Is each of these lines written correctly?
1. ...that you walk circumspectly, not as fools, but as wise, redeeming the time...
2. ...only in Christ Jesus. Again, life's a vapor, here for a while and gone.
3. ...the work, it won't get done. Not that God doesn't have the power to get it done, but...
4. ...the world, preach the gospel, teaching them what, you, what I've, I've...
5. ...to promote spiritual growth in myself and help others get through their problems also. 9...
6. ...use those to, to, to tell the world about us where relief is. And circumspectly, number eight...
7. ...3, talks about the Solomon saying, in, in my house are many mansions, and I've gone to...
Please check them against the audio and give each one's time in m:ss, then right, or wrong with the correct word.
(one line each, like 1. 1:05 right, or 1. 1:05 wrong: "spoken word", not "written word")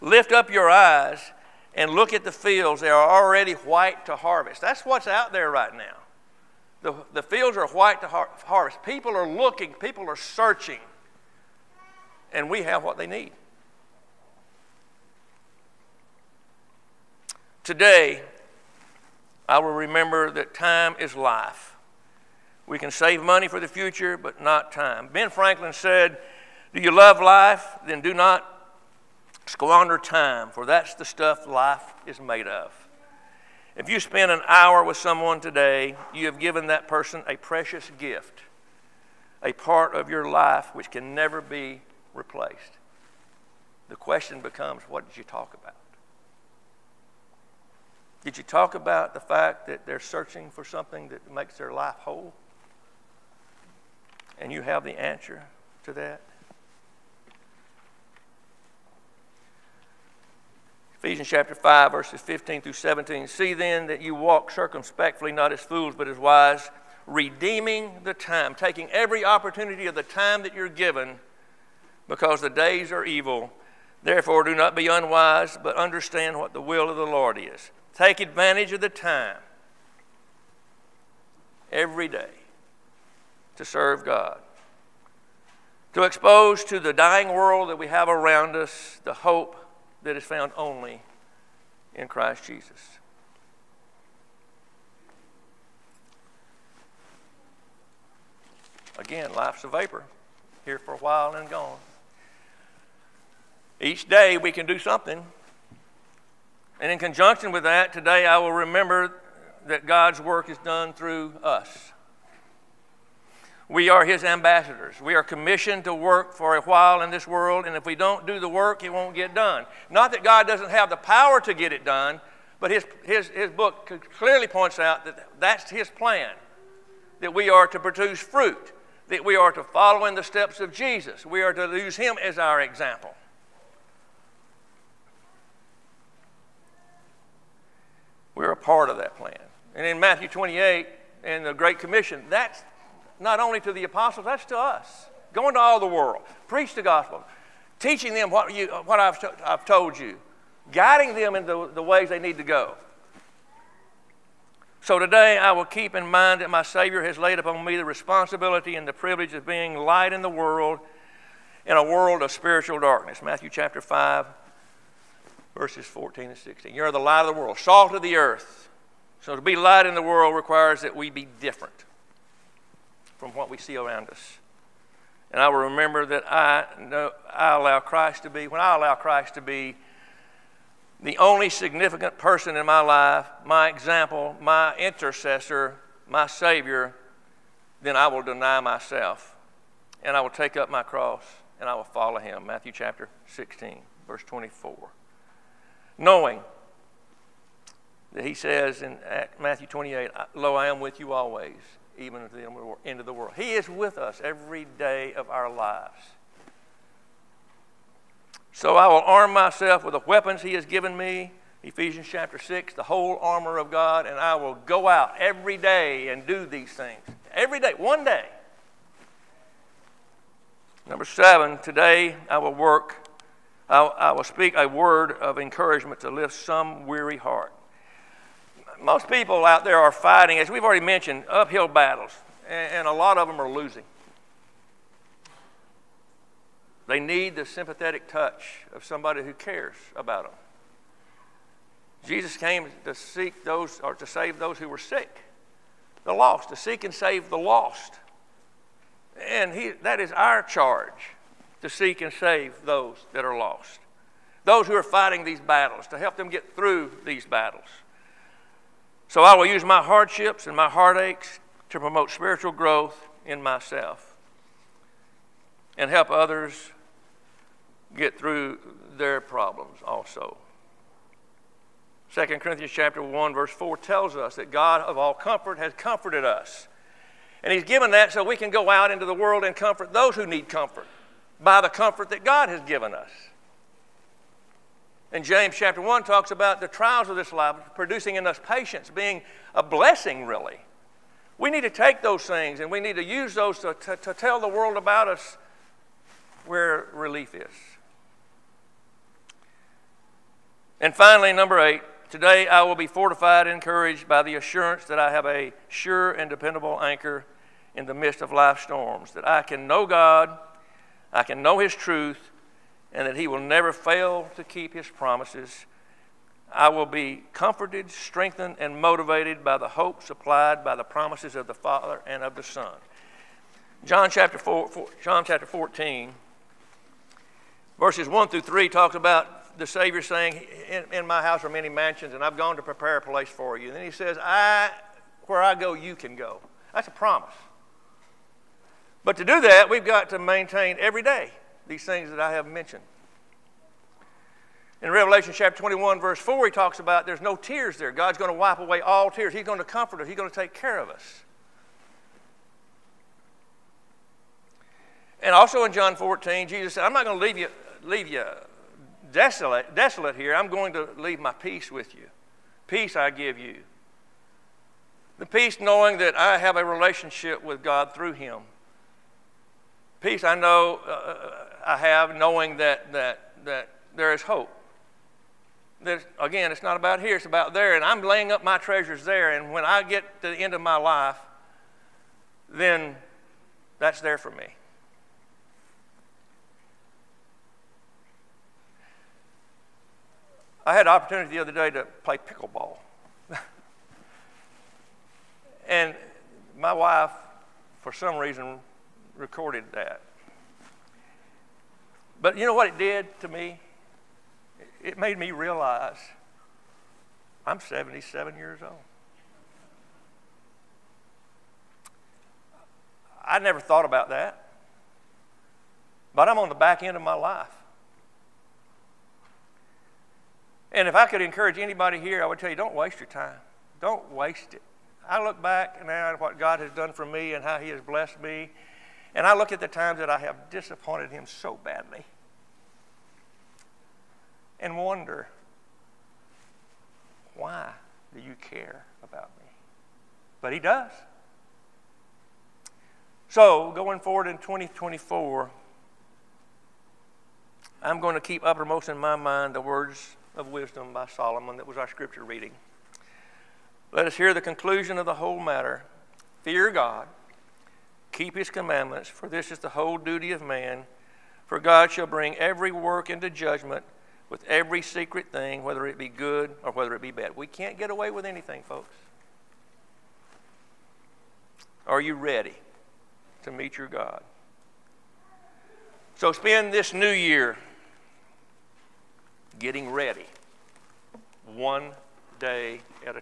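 1. 1:03 right
2. 1:30 right
3. 1:58 right
4. 2:25 right
5. 4:21 wrong: "2", not "9"
6. 4:53 wrong: "finally", not "circumspectly"
7. 5:28 wrong: "Savior", not "Solomon".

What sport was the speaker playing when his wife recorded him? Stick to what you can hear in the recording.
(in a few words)
Pickleball.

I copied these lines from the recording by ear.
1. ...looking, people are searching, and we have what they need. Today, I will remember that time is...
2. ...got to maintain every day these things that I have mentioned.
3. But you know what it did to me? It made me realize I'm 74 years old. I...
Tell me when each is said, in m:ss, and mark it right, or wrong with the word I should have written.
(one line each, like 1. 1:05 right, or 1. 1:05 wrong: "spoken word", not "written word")
1. 0:09 right
2. 5:39 right
3. 6:42 wrong: "77", not "74".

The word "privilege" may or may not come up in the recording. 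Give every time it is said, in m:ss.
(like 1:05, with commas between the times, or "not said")
2:38.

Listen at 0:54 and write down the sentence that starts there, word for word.
And you have the answer to that?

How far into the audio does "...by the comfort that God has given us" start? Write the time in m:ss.
4:41.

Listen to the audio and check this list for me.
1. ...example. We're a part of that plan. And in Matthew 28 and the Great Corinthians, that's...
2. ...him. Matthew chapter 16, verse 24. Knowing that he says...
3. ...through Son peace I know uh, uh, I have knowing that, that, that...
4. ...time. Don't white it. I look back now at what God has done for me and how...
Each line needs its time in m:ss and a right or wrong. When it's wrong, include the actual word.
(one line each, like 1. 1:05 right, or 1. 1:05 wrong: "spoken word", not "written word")
1. 2:12 wrong: "Commission", not "Corinthians"
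2. 3:12 right
3. 6:07 wrong: "Him", not "Son"
4. 7:03 wrong: "waste", not "white".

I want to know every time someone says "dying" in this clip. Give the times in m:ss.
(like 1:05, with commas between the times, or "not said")
1:26.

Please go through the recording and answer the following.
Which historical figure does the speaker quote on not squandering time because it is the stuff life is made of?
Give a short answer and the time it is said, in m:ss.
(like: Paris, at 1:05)
Ben Franklin, at 0:25.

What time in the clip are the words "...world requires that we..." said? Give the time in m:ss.
2:50.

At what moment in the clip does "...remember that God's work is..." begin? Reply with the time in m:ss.
1:48.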